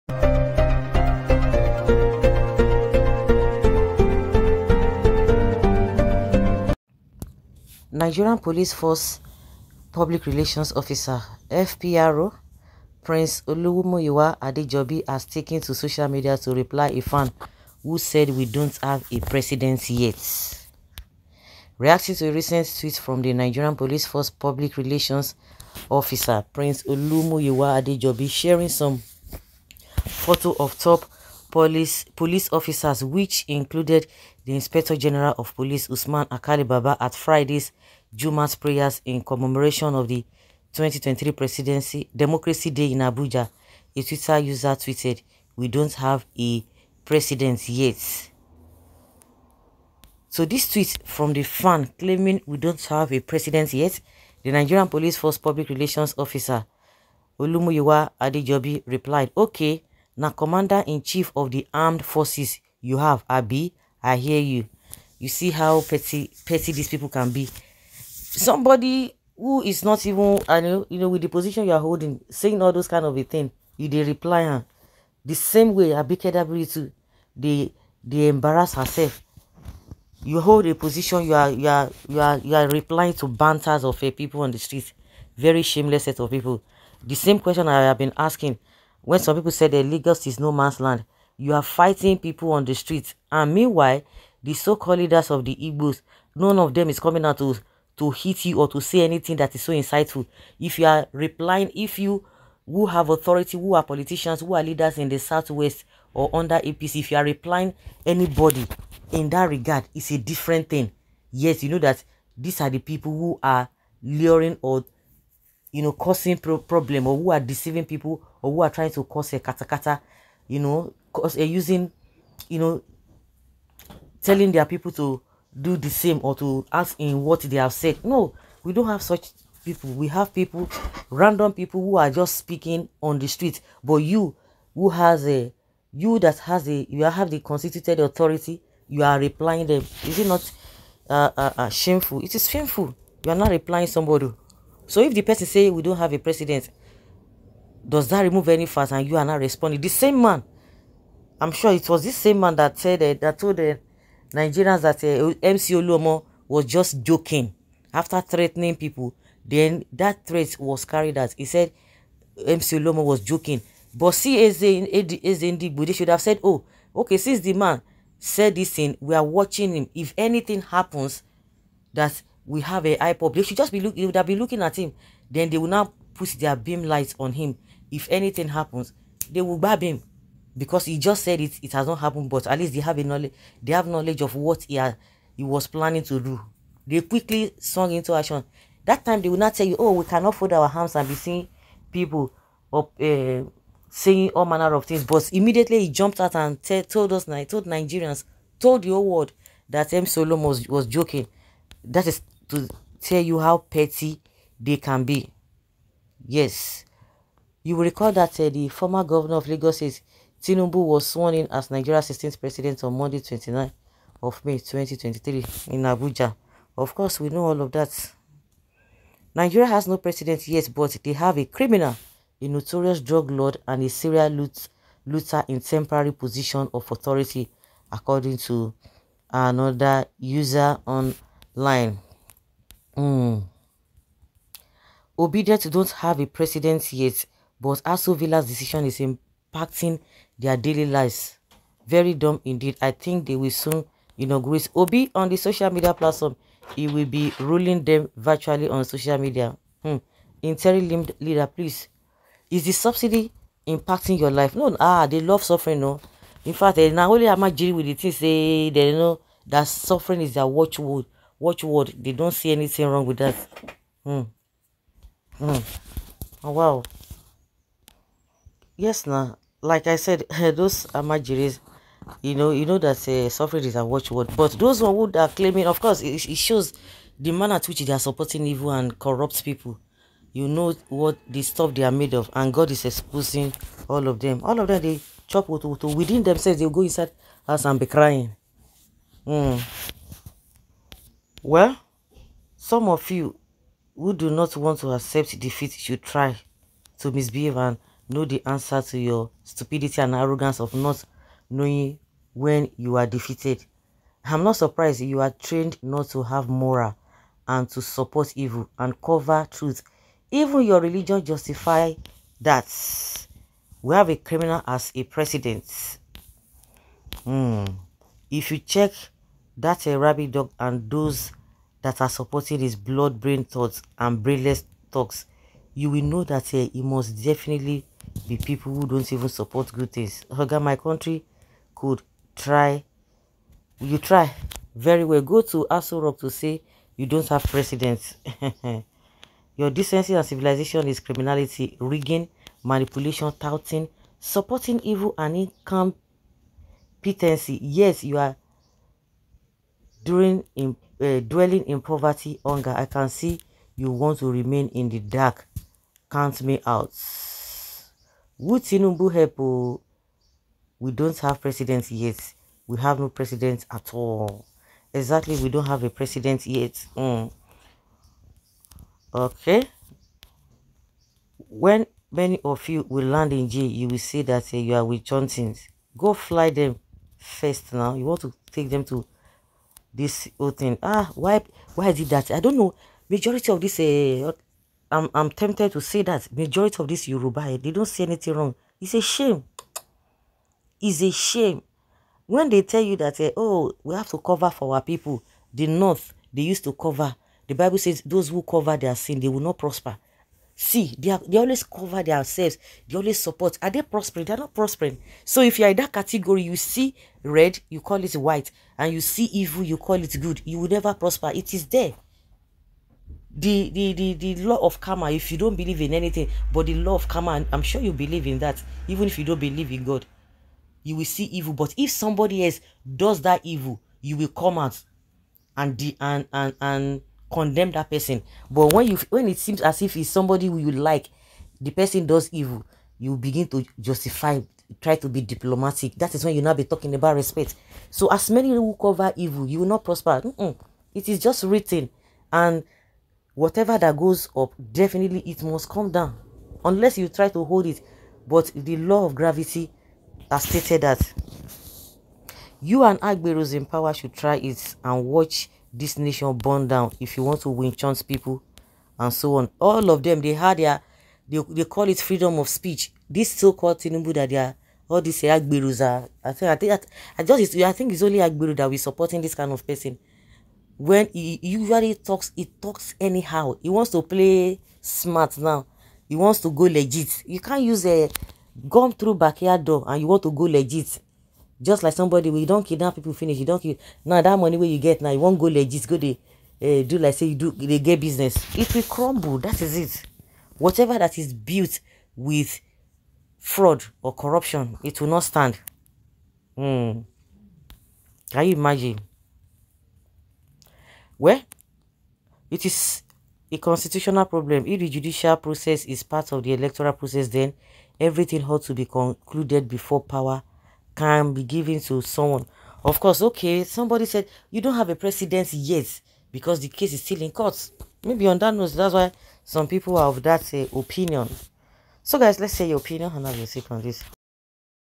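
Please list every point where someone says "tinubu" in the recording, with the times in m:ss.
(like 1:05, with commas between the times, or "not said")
3:30, 7:43.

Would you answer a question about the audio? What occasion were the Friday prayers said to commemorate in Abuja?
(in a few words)
Democracy Day.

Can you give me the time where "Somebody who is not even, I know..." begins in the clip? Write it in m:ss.
1:07.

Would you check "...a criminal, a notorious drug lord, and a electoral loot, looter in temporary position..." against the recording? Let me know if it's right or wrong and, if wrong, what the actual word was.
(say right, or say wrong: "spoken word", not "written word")
wrong: "serial", not "electoral".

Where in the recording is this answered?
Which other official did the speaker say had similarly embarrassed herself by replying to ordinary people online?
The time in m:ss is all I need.
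1:15.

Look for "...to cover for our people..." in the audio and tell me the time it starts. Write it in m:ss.
6:34.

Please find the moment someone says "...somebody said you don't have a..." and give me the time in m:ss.
8:33.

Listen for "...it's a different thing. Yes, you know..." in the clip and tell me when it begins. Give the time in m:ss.
1:49.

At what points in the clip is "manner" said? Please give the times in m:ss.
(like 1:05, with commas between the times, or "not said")
3:14, 4:37.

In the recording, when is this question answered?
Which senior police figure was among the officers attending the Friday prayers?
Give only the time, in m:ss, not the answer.
0:35.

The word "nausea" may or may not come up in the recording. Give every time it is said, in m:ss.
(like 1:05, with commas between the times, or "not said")
not said.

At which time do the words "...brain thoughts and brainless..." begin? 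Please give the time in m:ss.
5:23.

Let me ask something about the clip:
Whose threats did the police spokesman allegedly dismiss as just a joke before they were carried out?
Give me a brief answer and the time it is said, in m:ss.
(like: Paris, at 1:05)
MC Oluomo, at 2:35.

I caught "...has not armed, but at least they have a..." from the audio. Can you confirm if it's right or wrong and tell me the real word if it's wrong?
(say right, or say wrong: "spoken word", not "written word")
wrong: "happened", not "armed".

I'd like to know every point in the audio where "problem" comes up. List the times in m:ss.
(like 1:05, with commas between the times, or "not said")
1:56, 8:24.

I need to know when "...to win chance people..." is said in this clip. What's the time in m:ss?
7:37.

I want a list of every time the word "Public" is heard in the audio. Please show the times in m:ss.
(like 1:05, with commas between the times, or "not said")
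0:09, 0:24, 0:55.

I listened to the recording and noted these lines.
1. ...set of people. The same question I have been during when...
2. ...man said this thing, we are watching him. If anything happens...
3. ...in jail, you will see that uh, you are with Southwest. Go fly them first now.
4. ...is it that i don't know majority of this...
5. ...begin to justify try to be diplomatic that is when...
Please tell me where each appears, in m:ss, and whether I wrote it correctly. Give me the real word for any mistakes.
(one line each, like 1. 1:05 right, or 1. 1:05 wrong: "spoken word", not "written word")
1. 1:26 wrong: "asking", not "during"
2. 2:47 right
3. 6:13 wrong: "Johnsons", not "Southwest"
4. 6:21 right
5. 7:13 right.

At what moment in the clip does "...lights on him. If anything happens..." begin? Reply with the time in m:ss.
2:56.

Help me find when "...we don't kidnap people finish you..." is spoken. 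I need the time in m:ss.
8:02.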